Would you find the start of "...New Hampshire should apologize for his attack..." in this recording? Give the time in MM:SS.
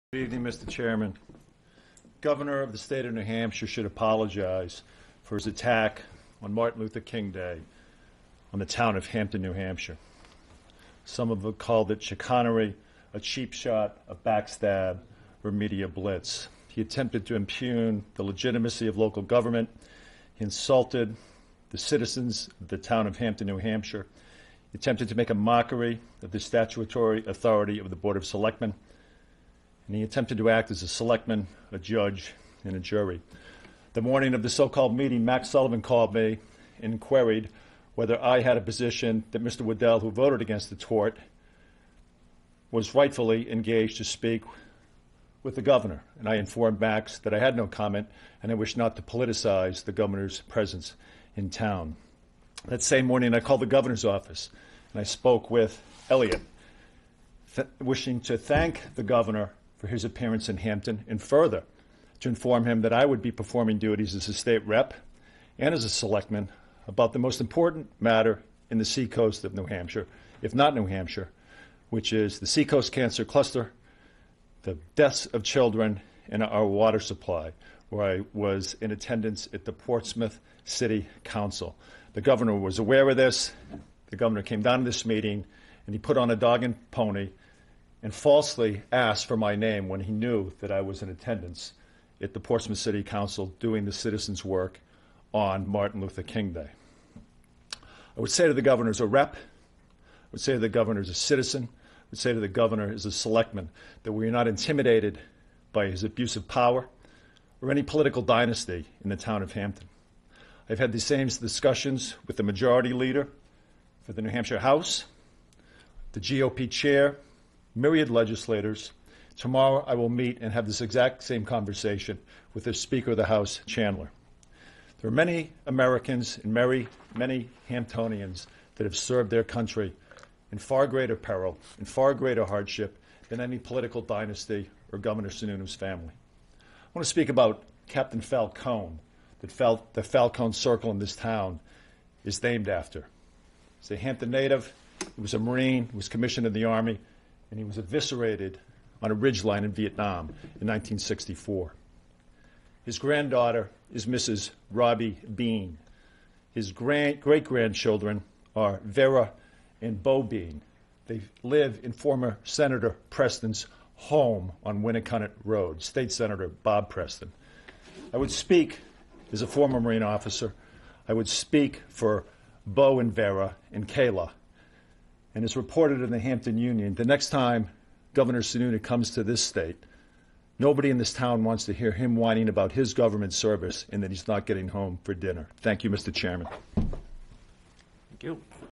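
00:03.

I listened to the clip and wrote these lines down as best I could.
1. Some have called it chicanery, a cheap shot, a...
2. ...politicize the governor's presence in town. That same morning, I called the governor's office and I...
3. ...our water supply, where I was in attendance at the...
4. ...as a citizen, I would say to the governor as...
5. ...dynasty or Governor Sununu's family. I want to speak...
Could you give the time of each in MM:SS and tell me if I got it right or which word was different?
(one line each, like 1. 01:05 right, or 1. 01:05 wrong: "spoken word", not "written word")
1. 00:11 right
2. 00:49 right
3. 01:16 right
4. 01:41 right
5. 02:14 right.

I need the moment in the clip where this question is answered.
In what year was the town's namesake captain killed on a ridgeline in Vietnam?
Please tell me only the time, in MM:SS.
02:30.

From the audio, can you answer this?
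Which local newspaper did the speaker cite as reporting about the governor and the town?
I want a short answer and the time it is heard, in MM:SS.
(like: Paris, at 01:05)
Hampton Union, at 02:56.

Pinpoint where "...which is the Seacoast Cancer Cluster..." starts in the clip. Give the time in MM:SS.
01:11.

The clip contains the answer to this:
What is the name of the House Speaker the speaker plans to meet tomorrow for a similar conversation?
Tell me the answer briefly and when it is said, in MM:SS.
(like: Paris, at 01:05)
Chandler, at 02:03.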